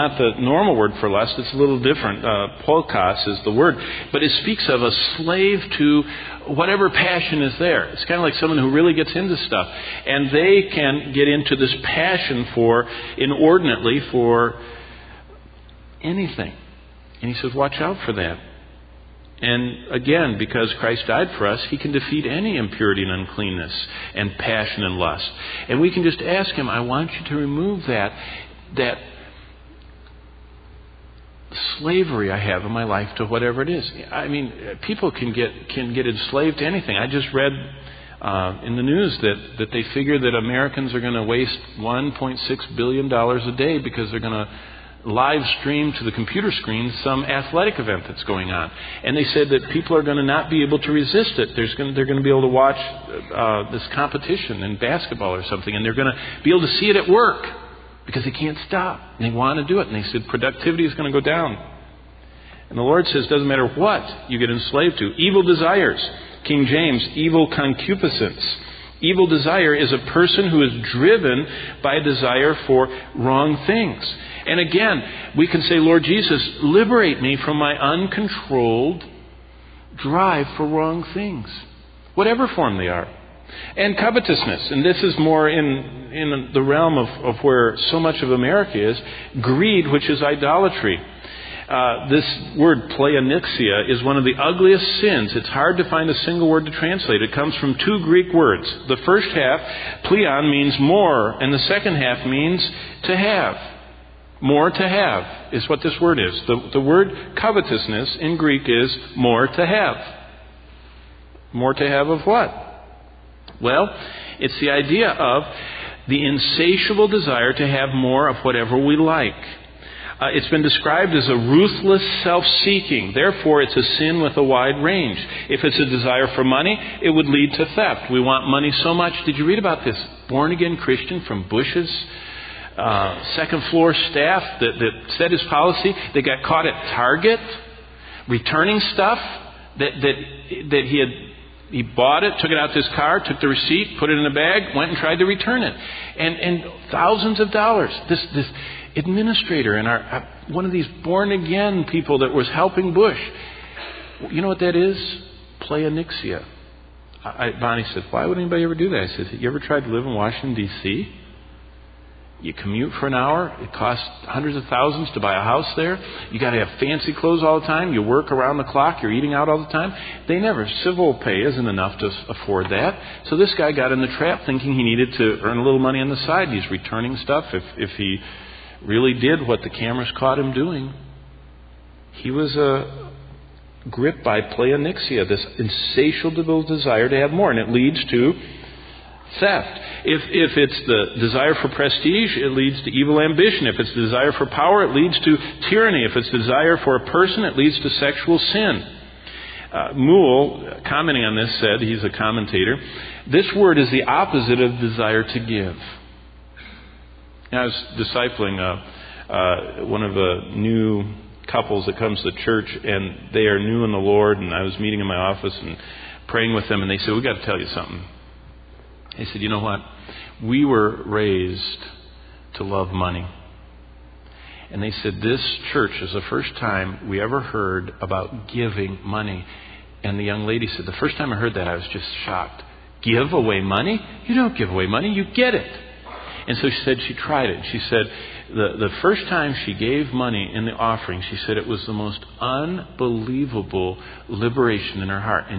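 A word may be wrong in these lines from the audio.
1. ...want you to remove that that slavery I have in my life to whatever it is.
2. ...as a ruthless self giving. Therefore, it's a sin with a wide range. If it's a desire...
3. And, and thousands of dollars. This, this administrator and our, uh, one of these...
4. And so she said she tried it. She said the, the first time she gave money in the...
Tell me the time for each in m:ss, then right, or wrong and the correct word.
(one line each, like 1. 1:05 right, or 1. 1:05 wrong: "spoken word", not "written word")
1. 0:26 right
2. 2:01 wrong: "seeking", not "giving"
3. 2:26 right
4. 3:56 right.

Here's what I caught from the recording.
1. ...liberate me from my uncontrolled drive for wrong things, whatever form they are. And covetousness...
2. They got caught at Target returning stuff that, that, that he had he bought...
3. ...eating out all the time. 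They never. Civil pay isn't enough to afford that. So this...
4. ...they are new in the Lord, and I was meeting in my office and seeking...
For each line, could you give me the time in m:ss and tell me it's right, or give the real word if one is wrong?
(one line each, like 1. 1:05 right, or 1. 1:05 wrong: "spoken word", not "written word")
1. 1:16 right
2. 2:16 right
3. 2:49 right
4. 3:33 wrong: "praying", not "seeking".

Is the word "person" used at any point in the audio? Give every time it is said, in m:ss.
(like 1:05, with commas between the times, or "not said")
1:10, 3:17.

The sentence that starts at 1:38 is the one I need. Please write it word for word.
The first half, pleon, means more, and the second half means to have.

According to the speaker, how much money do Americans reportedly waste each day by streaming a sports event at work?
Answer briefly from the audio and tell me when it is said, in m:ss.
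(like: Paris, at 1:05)
$1.6 billion, at 0:41.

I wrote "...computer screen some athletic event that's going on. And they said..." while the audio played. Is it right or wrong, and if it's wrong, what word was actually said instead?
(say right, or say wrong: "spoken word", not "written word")
right.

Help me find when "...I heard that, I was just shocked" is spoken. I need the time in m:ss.
3:51.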